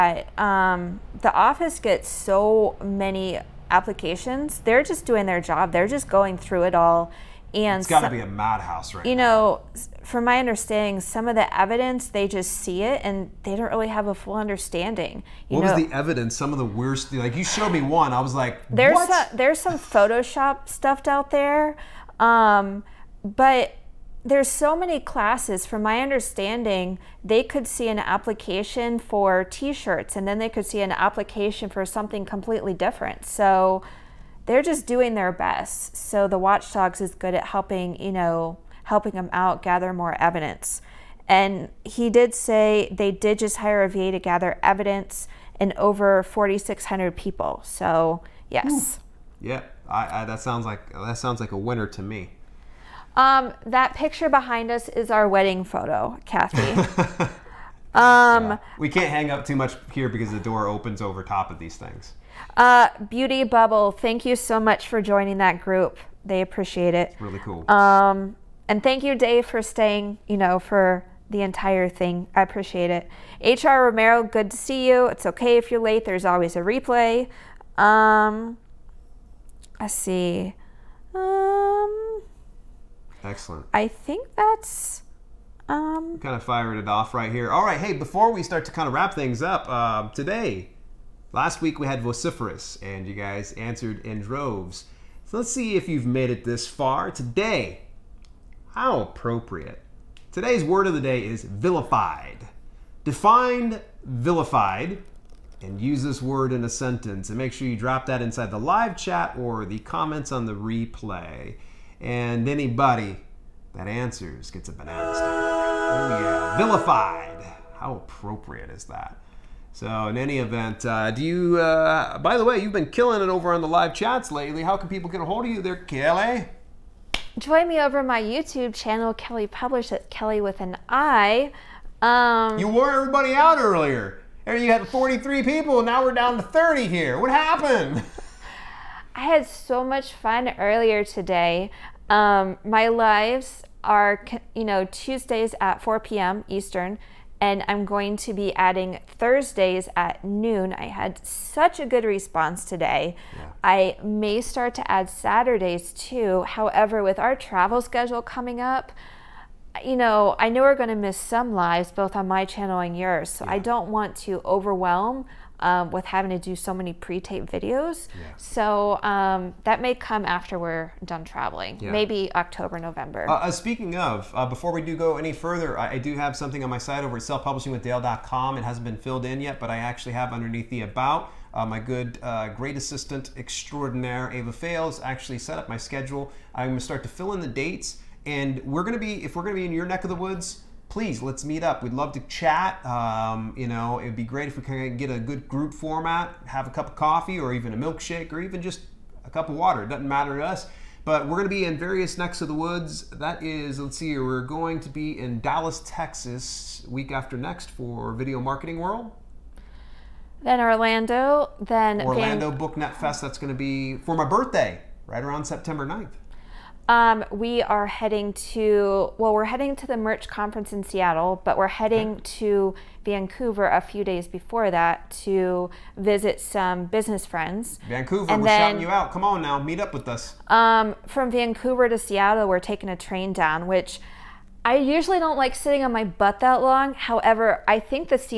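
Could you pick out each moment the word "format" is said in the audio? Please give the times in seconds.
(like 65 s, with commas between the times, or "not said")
195 s.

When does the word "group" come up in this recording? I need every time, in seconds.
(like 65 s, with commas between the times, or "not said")
65 s, 195 s.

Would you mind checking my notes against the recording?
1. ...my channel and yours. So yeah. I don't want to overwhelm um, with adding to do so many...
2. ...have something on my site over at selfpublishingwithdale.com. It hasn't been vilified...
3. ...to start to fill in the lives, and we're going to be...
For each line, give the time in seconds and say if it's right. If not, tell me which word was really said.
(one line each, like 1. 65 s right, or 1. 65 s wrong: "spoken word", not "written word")
1. 162 s wrong: "having", not "adding"
2. 176 s wrong: "filled", not "vilified"
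3. 186 s wrong: "dates", not "lives".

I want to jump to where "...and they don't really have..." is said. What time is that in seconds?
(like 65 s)
13 s.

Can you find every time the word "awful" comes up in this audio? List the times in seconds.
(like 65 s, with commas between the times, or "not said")
not said.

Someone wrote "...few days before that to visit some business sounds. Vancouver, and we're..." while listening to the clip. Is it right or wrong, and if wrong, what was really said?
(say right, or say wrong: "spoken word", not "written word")
wrong: "friends", not "sounds".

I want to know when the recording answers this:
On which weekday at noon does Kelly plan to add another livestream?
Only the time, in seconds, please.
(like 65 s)
149 s.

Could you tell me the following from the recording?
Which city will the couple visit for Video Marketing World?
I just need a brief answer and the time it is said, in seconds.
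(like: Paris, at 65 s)
Dallas, Texas, at 205 s.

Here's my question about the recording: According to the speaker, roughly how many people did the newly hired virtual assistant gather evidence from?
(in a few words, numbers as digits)
4,600.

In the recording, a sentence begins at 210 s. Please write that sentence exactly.
Then Orlando, then Orlando Van- Booknet Fest.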